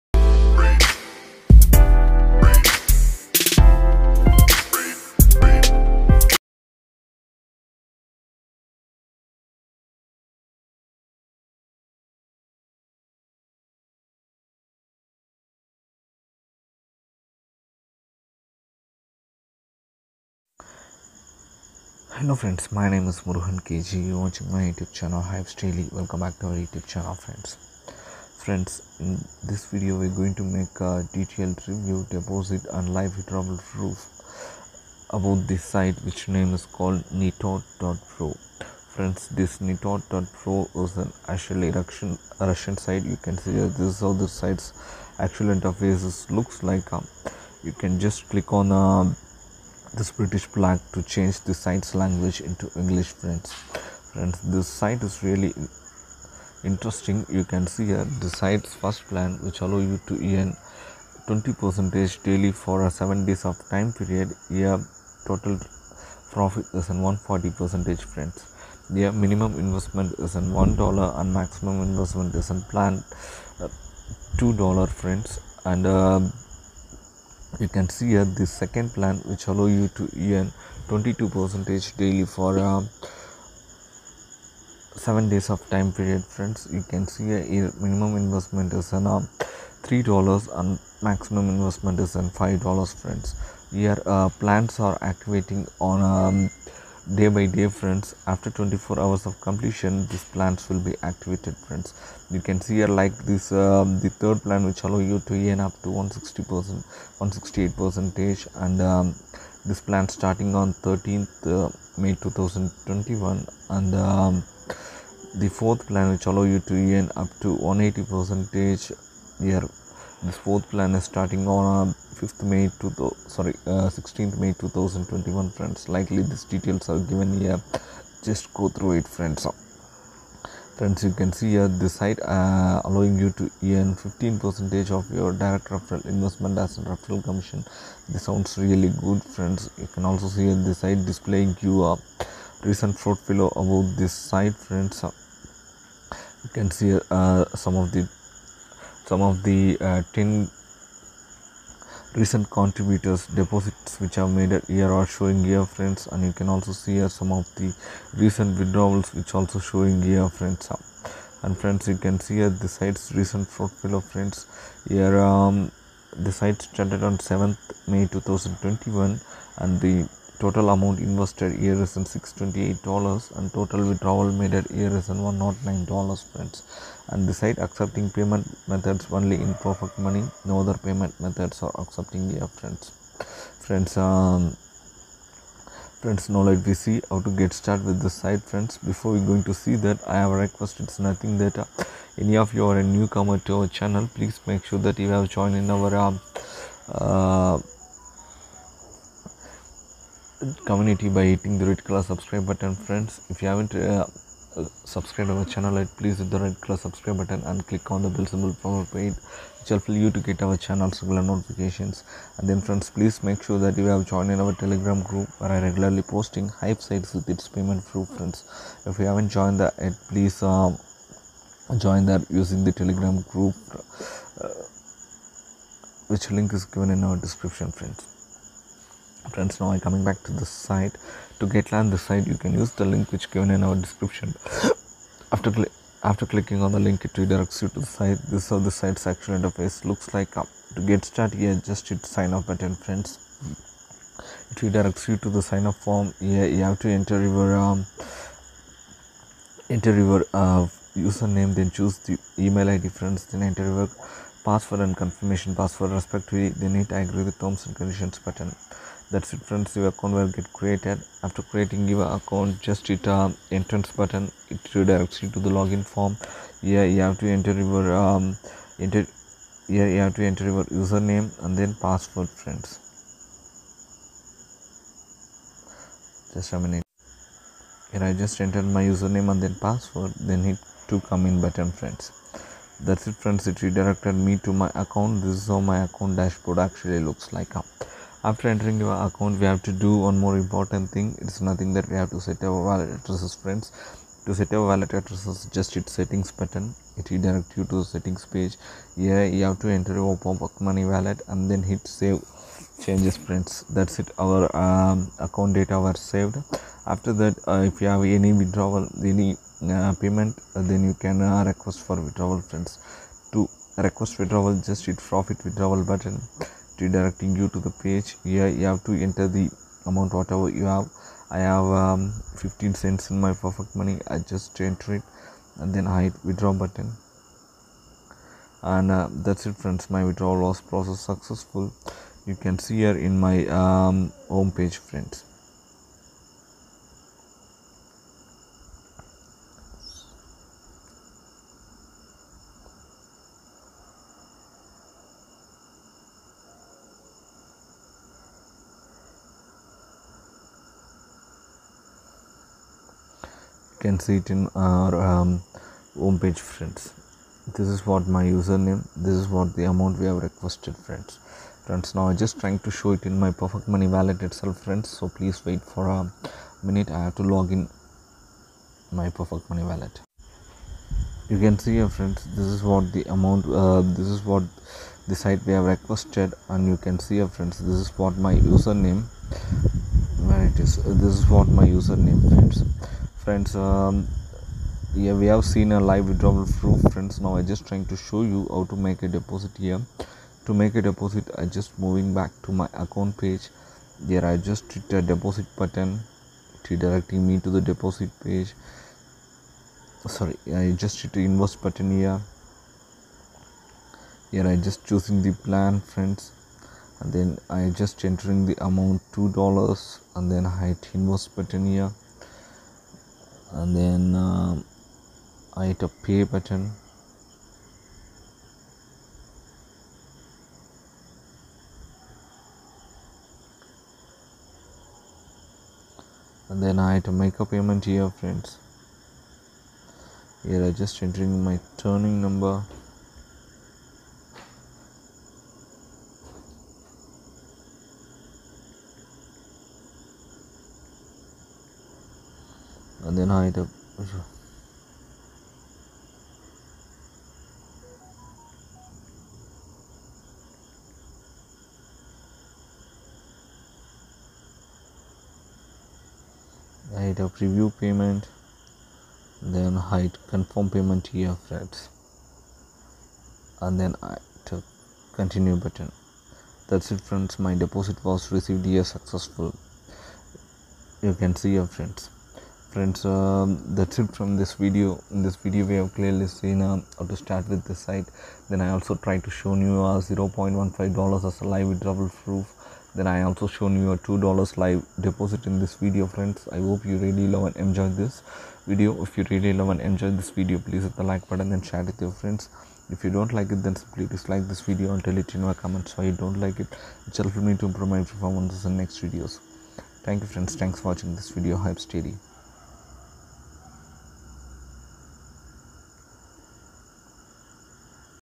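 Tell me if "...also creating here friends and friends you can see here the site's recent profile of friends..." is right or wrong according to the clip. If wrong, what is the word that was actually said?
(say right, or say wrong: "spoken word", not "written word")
wrong: "showing", not "creating".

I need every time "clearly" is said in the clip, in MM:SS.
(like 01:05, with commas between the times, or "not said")
07:55.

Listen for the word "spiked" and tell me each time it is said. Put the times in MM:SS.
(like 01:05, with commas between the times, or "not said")
not said.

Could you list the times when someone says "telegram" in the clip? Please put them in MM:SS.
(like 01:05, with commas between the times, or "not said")
03:34, 03:42.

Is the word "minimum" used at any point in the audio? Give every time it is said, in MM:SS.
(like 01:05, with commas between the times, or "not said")
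01:09, 01:27.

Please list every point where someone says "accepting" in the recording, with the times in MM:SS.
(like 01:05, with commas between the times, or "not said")
02:57, 03:01.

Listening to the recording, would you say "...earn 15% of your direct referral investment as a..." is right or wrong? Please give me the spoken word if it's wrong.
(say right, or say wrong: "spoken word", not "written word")
right.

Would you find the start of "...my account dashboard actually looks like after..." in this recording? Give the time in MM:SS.
04:45.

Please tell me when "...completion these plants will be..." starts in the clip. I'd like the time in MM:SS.
01:39.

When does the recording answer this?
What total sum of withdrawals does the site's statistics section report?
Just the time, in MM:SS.
02:55.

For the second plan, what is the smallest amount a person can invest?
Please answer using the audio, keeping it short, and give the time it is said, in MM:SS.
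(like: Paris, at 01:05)
$3, at 01:29.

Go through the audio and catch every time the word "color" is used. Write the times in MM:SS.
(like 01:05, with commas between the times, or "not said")
03:21, 03:26.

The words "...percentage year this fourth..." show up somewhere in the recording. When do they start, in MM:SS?
01:58.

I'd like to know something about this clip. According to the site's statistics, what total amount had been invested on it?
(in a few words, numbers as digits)
$628.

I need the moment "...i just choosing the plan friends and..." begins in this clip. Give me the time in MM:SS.
06:44.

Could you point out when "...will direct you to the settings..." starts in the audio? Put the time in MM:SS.
04:57.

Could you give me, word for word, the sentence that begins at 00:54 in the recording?
Friends, this site is really interesting.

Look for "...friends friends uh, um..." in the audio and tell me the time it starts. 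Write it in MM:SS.
07:51.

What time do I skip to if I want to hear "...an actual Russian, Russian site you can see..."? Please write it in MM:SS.
00:40.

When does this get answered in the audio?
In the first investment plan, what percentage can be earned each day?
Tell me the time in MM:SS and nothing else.
01:01.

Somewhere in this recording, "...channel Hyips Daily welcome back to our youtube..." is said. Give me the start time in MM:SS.
00:24.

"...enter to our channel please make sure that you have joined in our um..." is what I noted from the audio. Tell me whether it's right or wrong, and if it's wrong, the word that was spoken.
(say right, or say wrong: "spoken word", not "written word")
wrong: "newcomer", not "enter".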